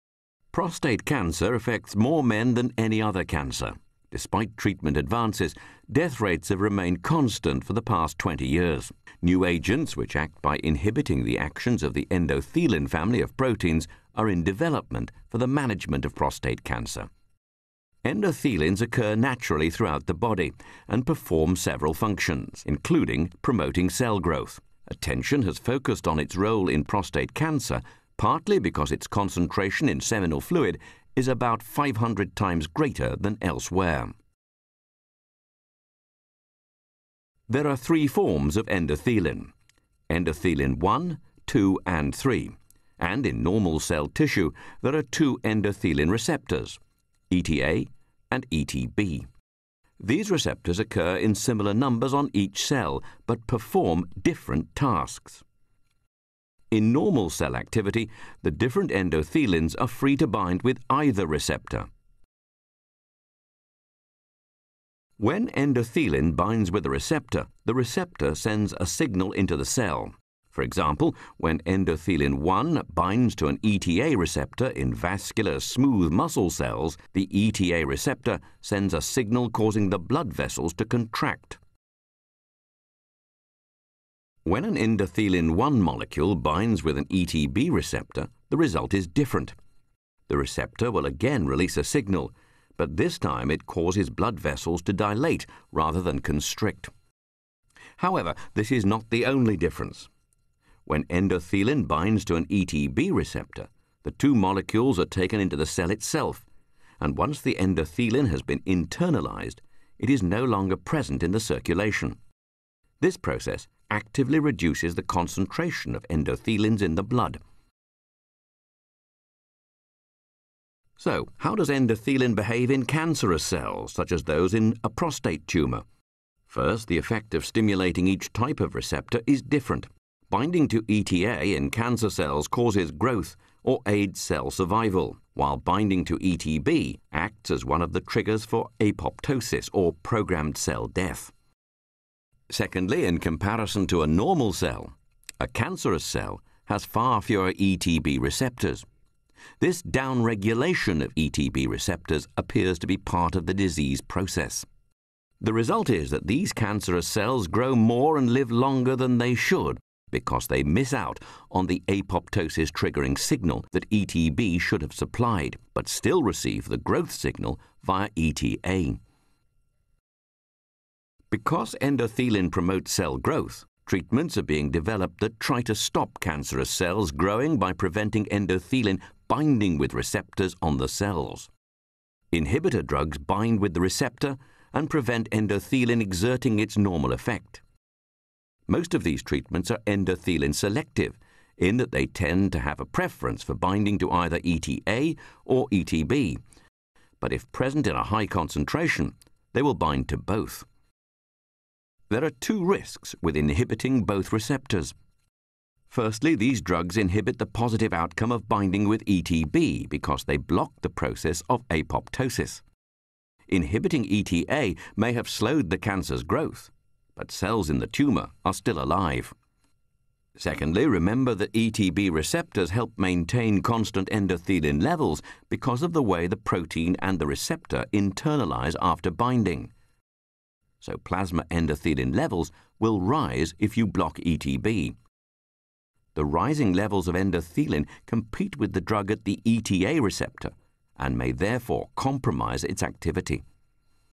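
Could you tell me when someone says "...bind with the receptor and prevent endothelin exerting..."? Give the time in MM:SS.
03:03.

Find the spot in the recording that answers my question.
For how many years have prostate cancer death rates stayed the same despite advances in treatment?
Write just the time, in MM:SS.
00:08.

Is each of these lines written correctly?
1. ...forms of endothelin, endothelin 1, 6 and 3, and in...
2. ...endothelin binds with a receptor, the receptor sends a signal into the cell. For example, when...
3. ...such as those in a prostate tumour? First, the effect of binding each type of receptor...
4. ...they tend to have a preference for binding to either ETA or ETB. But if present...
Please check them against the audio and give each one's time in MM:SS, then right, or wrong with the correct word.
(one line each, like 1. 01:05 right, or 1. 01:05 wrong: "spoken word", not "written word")
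1. 00:38 wrong: "2", not "6"
2. 01:05 right
3. 02:03 wrong: "stimulating", not "binding"
4. 03:11 right.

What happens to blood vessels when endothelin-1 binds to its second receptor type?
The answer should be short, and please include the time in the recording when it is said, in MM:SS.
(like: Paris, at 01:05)
dilate, at 01:34.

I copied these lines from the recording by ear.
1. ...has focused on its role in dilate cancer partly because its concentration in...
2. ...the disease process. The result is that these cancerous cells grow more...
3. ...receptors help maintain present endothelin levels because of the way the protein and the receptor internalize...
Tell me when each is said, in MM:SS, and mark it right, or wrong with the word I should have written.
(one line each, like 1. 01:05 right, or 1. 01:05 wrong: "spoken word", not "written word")
1. 00:25 wrong: "prostate", not "dilate"
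2. 02:33 right
3. 03:42 wrong: "constant", not "present".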